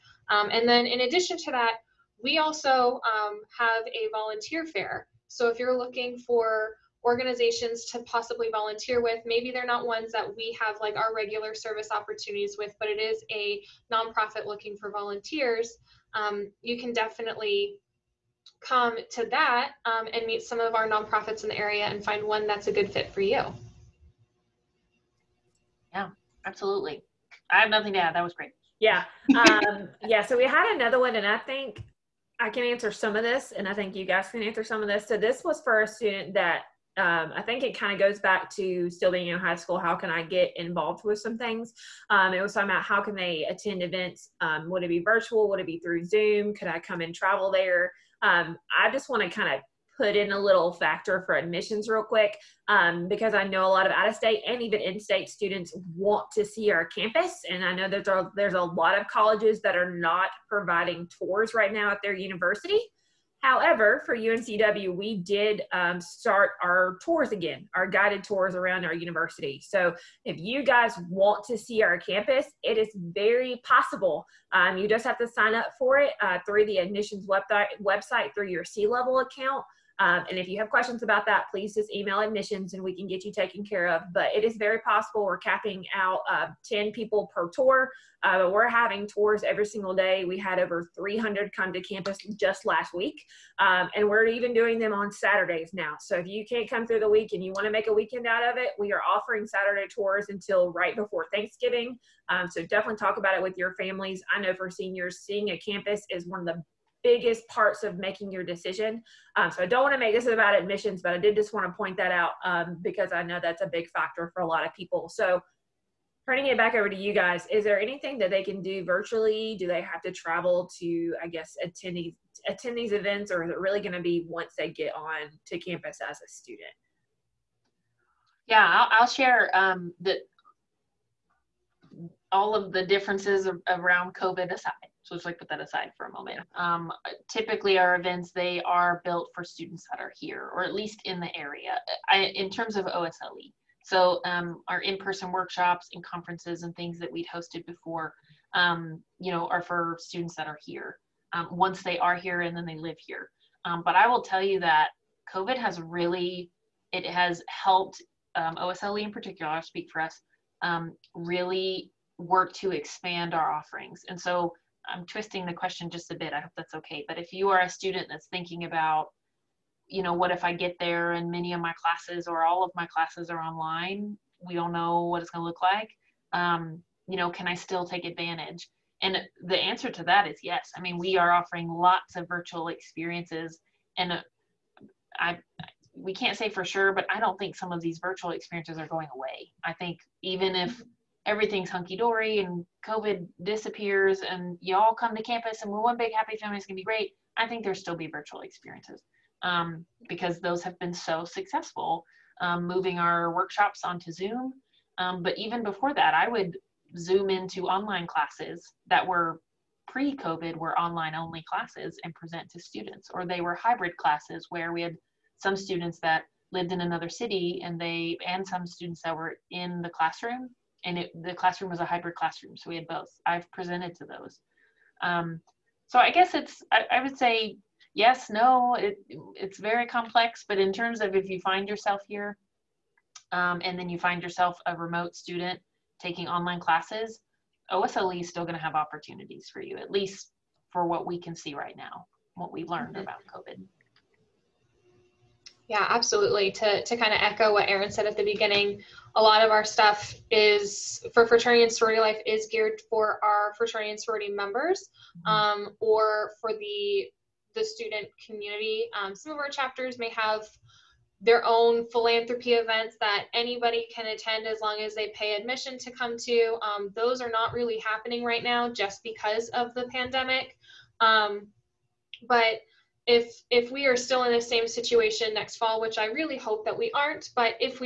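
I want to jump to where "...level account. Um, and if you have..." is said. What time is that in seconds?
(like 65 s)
78 s.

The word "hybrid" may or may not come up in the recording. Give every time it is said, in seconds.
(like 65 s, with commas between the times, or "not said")
213 s, 221 s.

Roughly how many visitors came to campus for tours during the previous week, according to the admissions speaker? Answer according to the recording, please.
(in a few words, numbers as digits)
over 300.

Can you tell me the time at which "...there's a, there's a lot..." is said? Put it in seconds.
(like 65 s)
58 s.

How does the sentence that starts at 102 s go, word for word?
Um, so definitely talk about it with your families.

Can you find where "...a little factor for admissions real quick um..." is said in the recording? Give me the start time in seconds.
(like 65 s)
50 s.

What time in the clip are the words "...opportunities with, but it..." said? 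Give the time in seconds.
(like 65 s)
11 s.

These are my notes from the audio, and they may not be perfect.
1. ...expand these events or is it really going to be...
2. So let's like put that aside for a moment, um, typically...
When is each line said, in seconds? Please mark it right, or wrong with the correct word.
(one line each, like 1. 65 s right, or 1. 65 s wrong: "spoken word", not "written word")
1. 122 s wrong: "attend", not "expand"
2. 135 s right.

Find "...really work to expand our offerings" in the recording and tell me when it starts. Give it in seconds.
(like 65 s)
161 s.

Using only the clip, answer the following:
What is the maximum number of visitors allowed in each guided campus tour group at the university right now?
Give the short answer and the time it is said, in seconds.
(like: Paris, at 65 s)
10, at 86 s.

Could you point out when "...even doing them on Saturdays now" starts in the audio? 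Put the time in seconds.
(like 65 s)
94 s.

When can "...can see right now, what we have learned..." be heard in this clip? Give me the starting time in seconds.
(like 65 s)
241 s.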